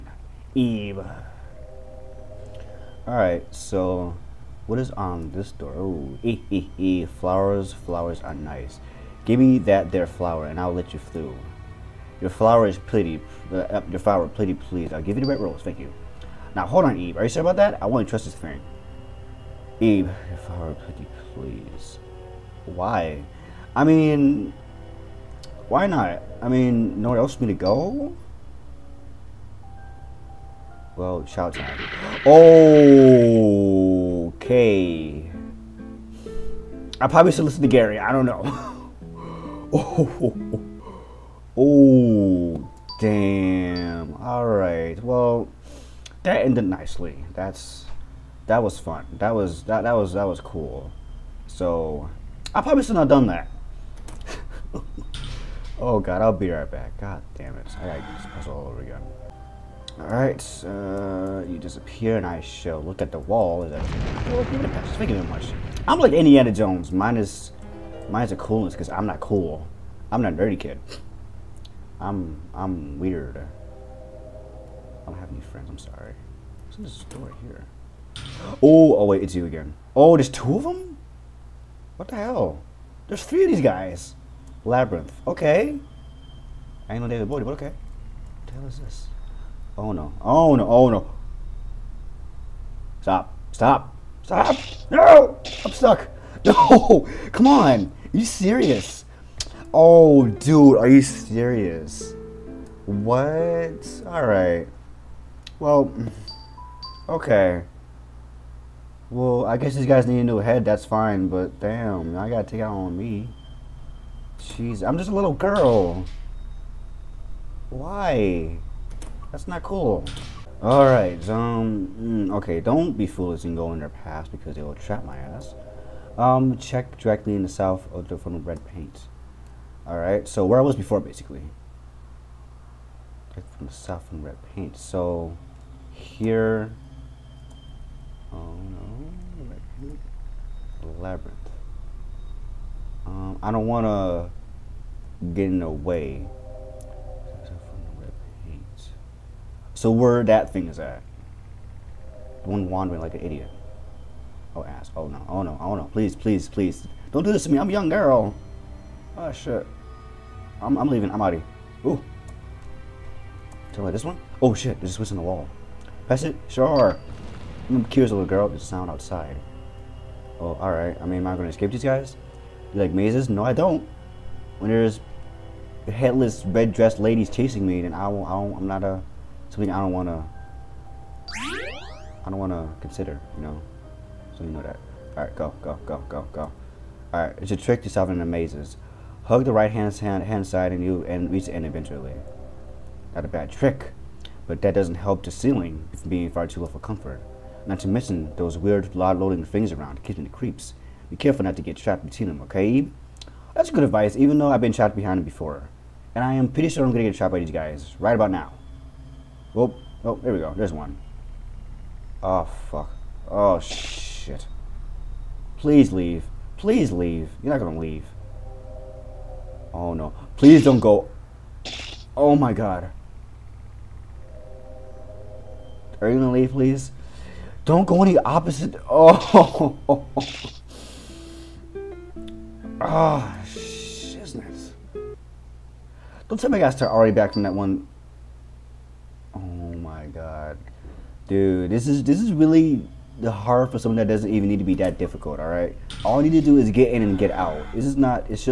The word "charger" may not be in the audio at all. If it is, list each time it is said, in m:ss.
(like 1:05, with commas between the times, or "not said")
not said.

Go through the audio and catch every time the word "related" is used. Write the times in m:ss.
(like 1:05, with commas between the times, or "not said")
not said.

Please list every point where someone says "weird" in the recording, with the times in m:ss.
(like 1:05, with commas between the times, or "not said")
1:12, 3:18.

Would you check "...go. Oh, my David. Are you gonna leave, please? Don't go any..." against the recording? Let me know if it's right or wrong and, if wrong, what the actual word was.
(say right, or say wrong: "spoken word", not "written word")
wrong: "God", not "David".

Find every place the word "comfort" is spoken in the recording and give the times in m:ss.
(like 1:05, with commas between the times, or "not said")
3:16.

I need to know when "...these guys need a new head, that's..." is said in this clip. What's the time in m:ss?
1:49.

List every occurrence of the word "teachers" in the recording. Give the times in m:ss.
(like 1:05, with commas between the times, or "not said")
not said.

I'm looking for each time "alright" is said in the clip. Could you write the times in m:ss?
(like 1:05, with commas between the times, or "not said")
0:03, 0:59, 1:44, 2:00, 2:09, 2:50, 4:05.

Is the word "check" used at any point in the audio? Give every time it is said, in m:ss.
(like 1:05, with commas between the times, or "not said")
2:06, 2:13.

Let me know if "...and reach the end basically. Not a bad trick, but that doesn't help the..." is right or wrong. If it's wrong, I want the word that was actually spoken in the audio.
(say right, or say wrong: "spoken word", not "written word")
wrong: "eventually", not "basically".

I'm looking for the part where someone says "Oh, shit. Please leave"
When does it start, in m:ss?
3:33.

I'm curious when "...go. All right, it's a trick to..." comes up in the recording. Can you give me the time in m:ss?
3:06.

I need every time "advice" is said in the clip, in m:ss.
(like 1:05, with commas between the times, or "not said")
3:23.